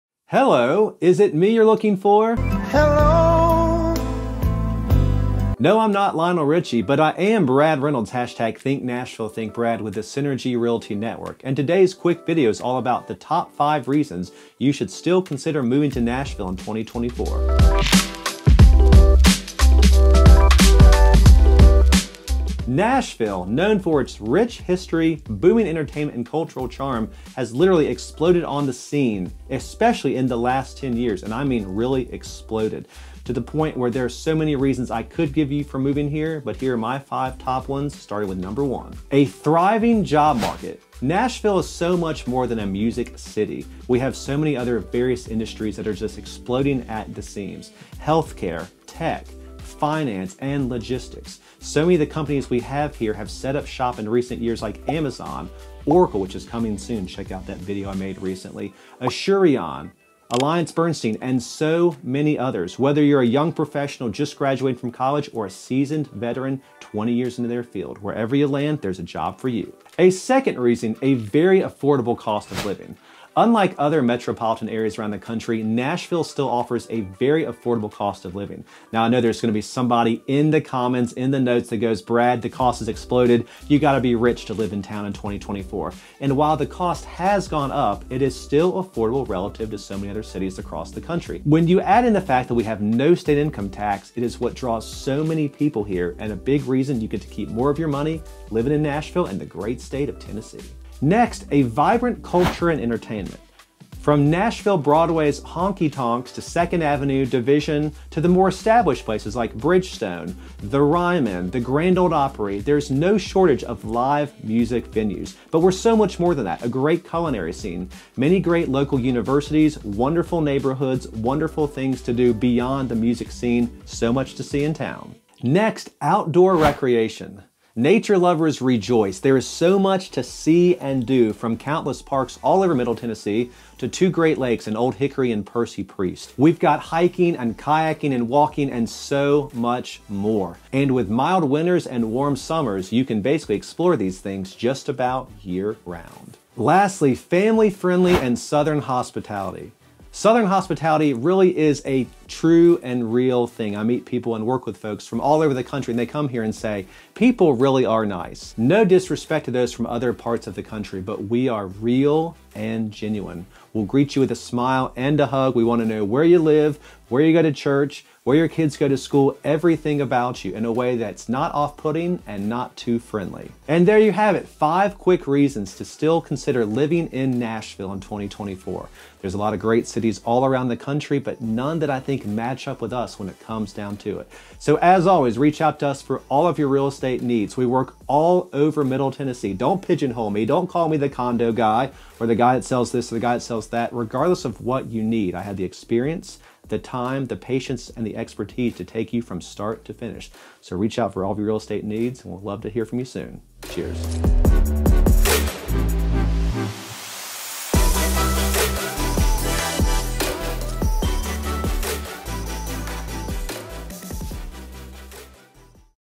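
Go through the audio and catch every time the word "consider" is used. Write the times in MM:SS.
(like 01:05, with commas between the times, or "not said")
00:15, 02:56.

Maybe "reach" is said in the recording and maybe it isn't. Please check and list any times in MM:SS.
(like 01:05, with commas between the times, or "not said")
03:05, 03:20.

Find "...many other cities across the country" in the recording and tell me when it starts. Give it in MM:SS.
01:29.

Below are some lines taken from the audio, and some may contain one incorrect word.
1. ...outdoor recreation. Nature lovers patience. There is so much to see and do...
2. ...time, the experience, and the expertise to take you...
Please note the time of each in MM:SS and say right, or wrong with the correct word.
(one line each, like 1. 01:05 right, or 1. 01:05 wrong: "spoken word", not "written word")
1. 02:06 wrong: "rejoice", not "patience"
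2. 03:16 wrong: "patience", not "experience".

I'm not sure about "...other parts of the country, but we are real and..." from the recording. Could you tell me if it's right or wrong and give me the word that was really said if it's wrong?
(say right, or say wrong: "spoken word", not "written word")
right.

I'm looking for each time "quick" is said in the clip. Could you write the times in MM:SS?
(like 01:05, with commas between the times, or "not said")
00:11, 02:54.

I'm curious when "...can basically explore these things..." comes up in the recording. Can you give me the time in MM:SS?
02:23.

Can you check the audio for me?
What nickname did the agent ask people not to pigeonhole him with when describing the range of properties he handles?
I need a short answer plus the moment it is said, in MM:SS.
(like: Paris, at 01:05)
the condo guy, at 03:10.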